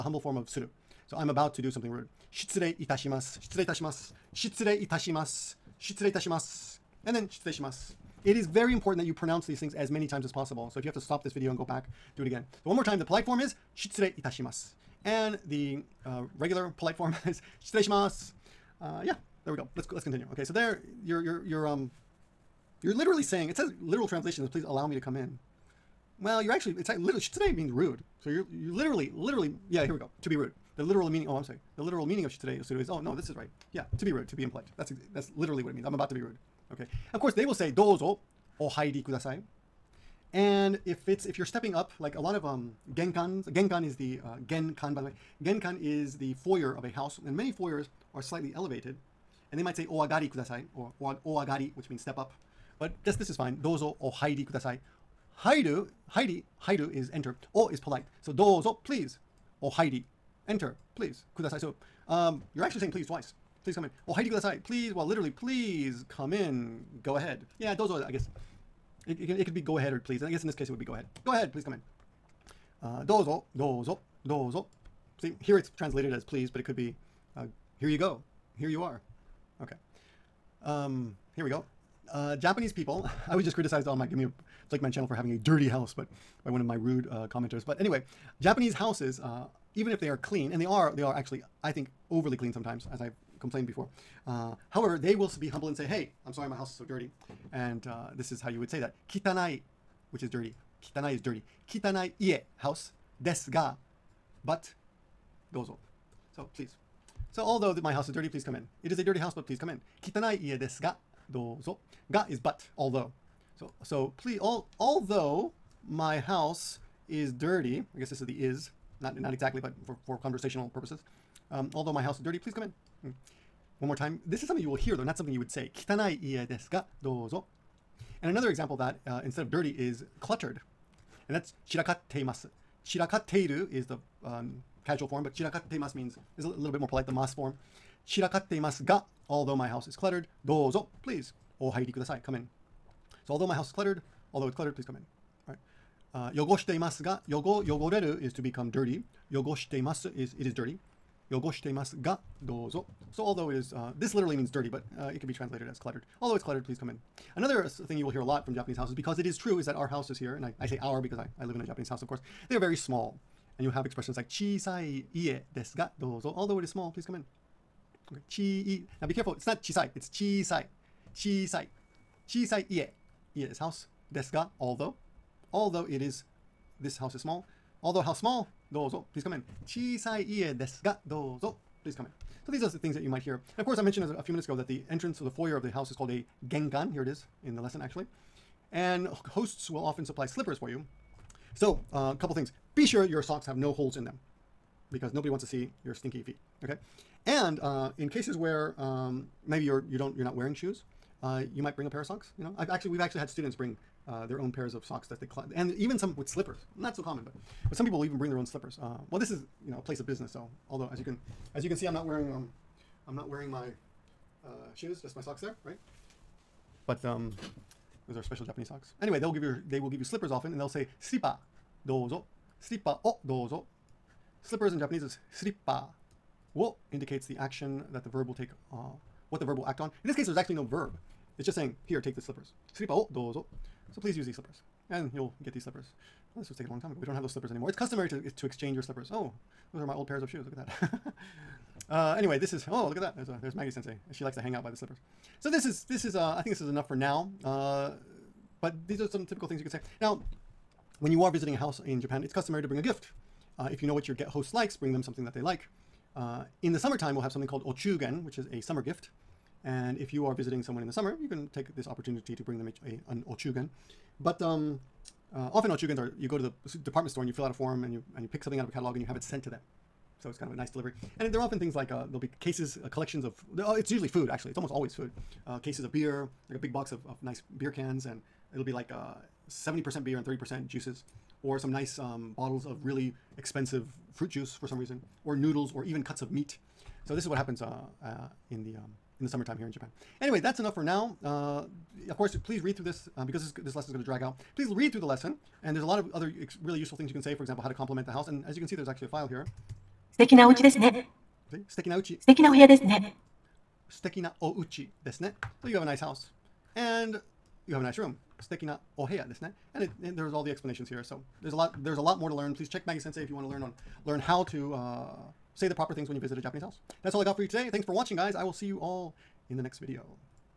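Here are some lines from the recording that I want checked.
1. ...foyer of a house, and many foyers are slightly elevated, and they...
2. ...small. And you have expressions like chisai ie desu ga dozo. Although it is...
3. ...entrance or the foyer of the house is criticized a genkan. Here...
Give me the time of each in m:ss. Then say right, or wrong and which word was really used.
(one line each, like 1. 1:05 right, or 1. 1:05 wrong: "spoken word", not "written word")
1. 0:46 right
2. 2:42 right
3. 3:04 wrong: "called", not "criticized".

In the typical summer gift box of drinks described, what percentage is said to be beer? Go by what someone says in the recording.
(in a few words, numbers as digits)
70 percent.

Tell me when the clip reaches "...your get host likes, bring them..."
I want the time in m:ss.
4:14.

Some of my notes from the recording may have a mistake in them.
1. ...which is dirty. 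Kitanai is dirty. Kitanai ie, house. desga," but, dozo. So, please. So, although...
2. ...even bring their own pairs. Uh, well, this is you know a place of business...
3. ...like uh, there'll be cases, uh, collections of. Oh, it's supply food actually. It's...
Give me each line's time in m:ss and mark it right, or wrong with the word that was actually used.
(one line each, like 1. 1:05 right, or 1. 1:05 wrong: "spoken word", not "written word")
1. 1:40 right
2. 3:28 wrong: "slippers", not "pairs"
3. 4:31 wrong: "usually", not "supply".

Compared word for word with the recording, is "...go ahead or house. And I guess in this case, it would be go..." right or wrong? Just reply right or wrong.
wrong.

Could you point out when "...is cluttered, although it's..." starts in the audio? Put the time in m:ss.
2:23.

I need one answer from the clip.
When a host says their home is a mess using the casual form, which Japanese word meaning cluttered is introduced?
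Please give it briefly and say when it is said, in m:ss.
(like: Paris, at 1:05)
Chirakatteiru, at 2:12.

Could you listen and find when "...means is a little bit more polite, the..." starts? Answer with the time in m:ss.
2:15.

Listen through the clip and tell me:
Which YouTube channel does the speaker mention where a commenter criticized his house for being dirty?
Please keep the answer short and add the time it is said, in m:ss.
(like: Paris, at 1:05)
Give Me a Flake Man, at 1:24.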